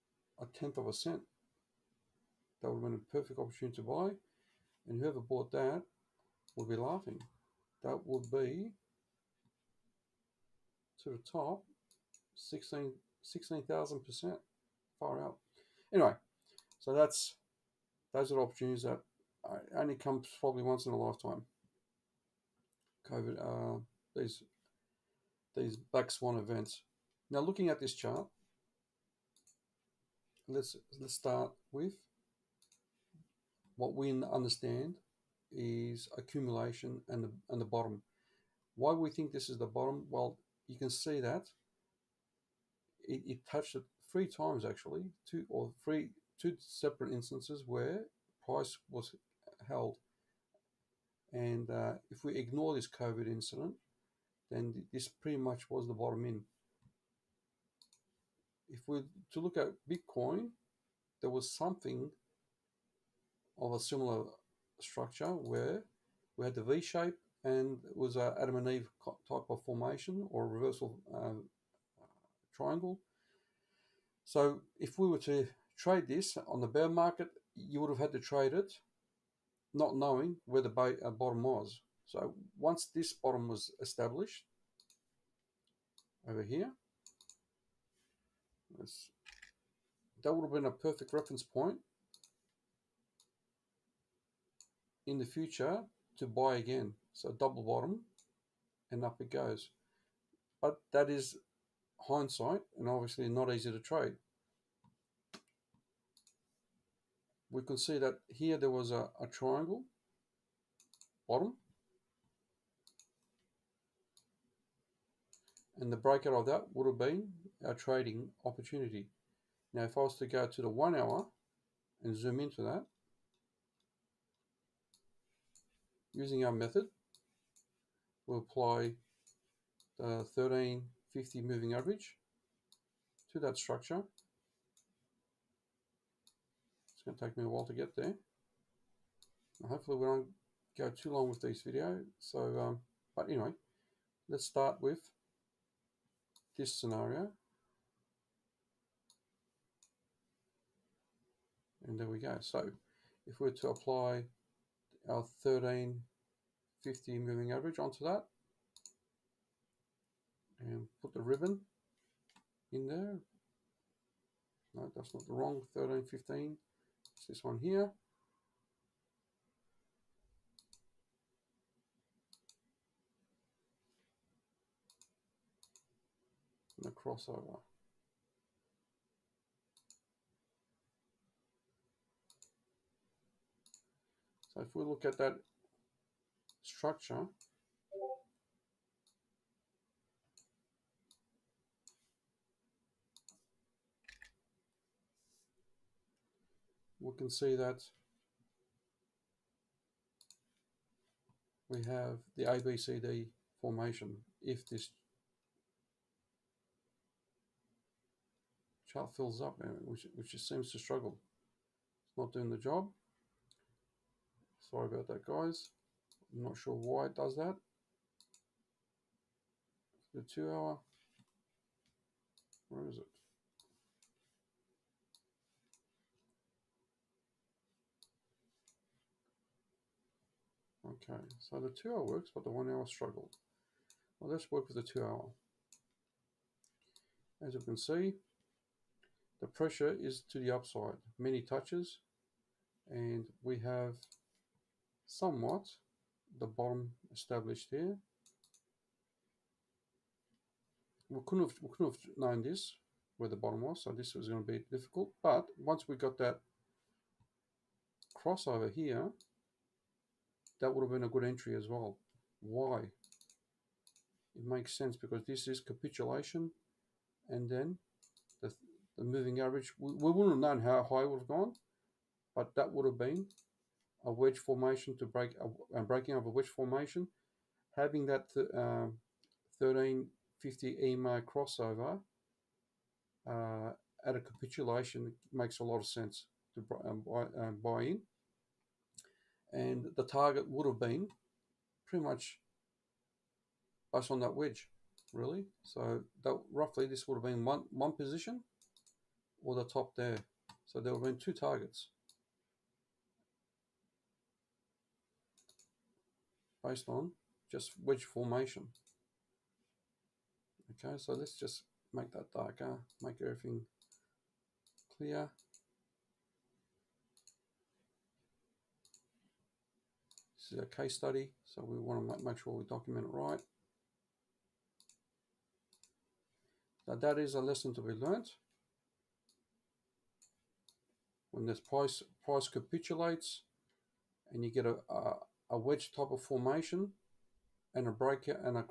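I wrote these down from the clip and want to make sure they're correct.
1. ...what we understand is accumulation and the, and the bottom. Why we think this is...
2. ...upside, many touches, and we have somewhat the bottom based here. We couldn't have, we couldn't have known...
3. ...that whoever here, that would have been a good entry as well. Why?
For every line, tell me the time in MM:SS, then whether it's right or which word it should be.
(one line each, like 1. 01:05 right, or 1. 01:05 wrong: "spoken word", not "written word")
1. 00:33 right
2. 04:00 wrong: "established", not "based"
3. 04:16 wrong: "crossover", not "whoever".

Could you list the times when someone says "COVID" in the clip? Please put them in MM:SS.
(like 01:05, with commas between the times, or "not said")
00:23, 00:52.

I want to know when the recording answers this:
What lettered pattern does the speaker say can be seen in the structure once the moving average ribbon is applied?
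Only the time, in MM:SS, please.
03:22.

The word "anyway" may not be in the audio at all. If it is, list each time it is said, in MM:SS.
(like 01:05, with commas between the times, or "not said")
00:15, 02:23.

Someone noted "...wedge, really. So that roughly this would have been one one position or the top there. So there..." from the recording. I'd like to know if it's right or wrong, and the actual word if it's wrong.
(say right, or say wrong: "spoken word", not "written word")
right.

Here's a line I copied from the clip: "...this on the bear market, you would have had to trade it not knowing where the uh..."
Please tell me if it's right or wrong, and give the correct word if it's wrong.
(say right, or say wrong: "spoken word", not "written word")
right.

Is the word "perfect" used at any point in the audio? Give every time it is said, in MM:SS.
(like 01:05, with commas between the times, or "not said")
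00:03, 01:30.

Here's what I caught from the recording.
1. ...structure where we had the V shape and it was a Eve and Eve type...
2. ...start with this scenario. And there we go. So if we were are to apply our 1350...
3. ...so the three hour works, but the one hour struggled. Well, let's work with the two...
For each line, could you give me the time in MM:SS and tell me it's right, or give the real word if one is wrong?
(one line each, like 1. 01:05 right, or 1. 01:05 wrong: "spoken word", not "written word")
1. 01:04 wrong: "Adam", not "Eve"
2. 02:24 right
3. 03:51 wrong: "two", not "three".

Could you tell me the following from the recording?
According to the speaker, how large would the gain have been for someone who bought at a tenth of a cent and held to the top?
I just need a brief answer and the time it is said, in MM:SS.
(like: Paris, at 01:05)
16,000 percent, at 00:12.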